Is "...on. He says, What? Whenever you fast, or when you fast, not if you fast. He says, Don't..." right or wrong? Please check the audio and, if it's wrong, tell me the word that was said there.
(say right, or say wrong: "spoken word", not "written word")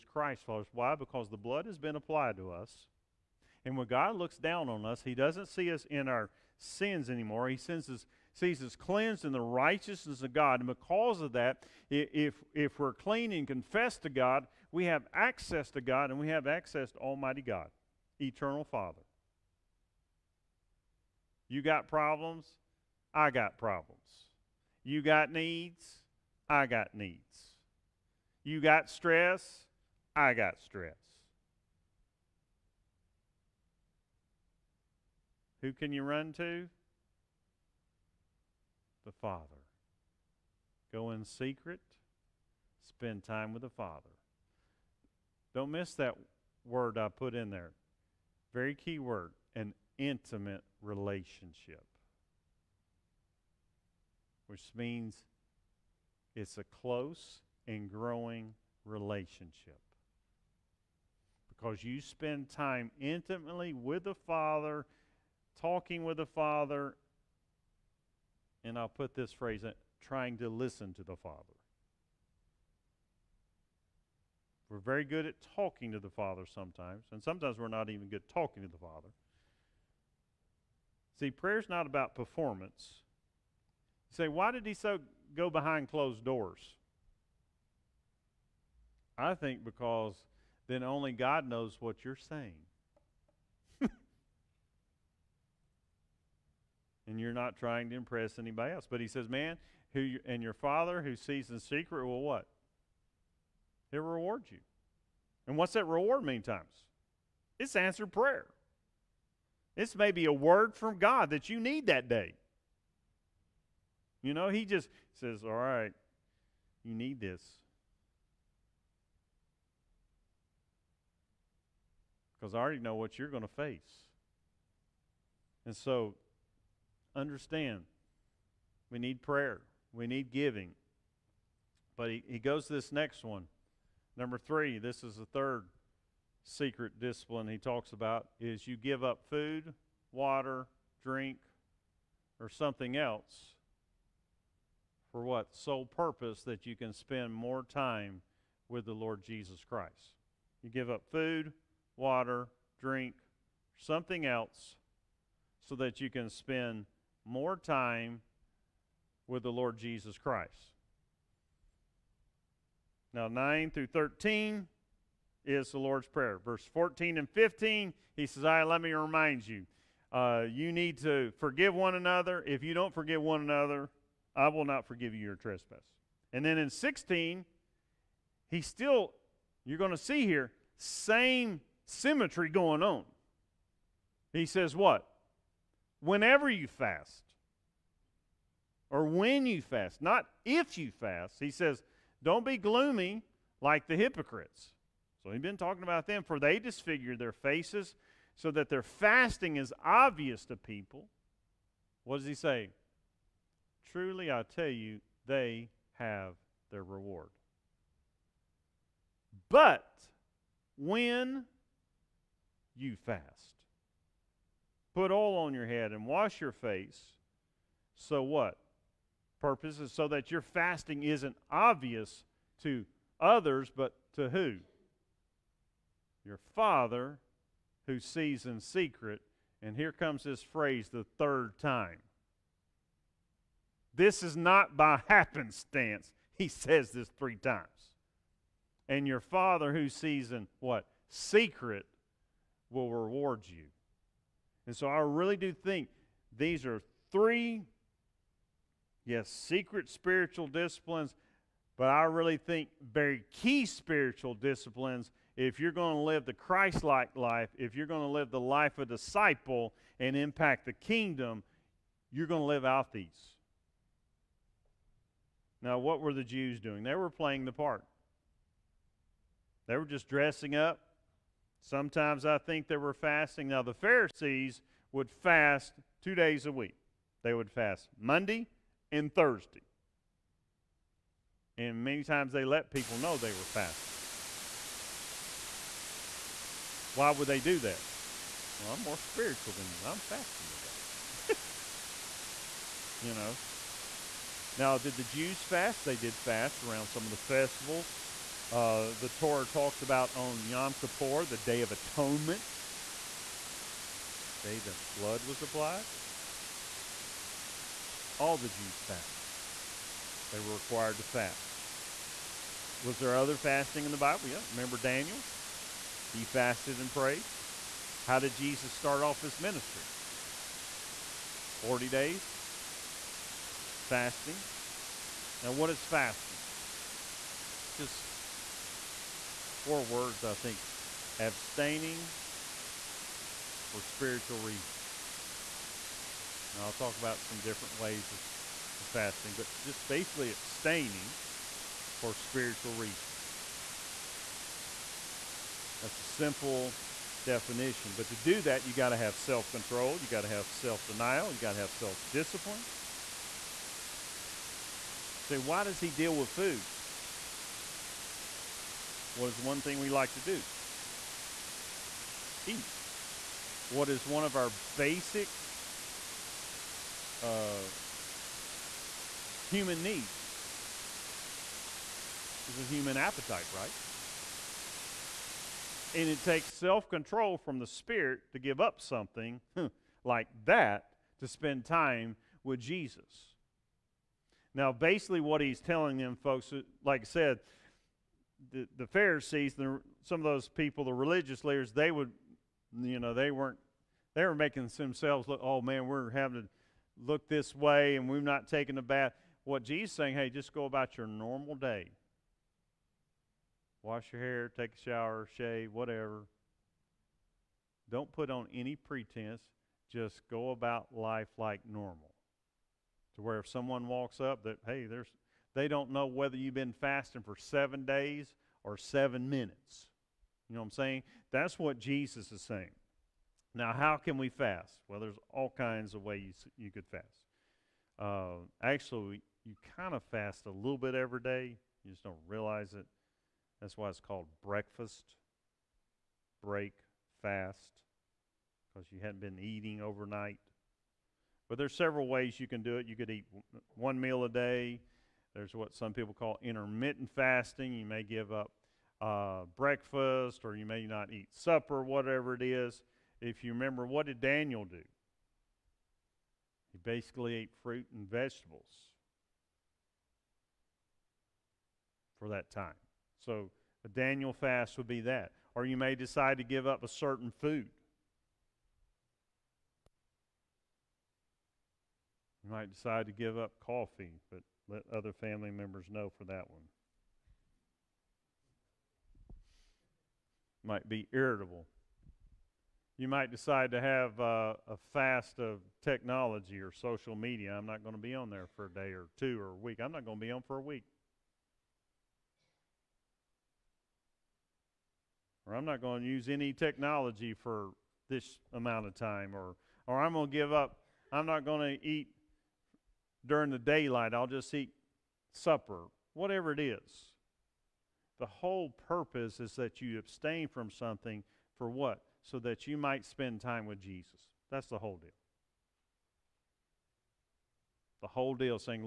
right.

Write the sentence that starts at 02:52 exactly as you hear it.
If you don't forgive one another, I will not forgive you your trespass.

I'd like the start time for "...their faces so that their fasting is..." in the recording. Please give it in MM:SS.
03:17.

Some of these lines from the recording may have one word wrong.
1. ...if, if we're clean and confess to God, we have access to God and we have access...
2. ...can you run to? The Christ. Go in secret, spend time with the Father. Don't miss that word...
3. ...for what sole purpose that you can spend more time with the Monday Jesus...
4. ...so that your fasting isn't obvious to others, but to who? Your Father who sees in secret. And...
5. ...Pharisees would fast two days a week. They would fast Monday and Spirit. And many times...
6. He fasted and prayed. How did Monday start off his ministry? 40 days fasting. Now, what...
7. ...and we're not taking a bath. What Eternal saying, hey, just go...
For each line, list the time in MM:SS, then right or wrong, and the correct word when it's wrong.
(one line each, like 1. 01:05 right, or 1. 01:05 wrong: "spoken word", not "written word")
1. 00:11 right
2. 00:35 wrong: "Father", not "Christ"
3. 02:25 wrong: "Lord", not "Monday"
4. 03:39 right
5. 04:33 wrong: "Thursday", not "Spirit"
6. 05:16 wrong: "Jesus", not "Monday"
7. 06:37 wrong: "Jesus", not "Eternal".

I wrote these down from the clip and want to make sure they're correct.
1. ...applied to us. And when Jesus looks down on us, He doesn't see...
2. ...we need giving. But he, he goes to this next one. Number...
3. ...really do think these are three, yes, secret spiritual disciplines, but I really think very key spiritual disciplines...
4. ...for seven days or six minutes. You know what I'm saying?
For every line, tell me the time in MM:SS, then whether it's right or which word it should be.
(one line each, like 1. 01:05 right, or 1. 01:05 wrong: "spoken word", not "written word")
1. 00:01 wrong: "God", not "Jesus"
2. 02:09 right
3. 04:04 right
4. 06:57 wrong: "seven", not "six".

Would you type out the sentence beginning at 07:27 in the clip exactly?
You may give up uh, breakfast or you may not eat supper, whatever it is.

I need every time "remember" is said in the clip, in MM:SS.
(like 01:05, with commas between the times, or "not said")
05:14, 07:33.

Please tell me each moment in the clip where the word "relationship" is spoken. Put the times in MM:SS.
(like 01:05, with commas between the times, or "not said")
00:50, 00:58.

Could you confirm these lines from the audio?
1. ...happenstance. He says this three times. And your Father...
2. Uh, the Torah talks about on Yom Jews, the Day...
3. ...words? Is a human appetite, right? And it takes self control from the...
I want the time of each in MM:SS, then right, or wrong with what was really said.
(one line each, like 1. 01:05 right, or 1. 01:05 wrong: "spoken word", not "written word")
1. 03:55 right
2. 04:58 wrong: "Kippur", not "Jews"
3. 06:09 wrong: "needs", not "words".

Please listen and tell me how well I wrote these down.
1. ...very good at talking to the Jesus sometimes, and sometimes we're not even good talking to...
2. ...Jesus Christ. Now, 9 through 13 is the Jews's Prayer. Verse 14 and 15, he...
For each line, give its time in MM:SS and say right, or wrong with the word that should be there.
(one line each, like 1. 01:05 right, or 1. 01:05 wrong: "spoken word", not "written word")
1. 01:14 wrong: "Father", not "Jesus"
2. 02:39 wrong: "Lord", not "Jews".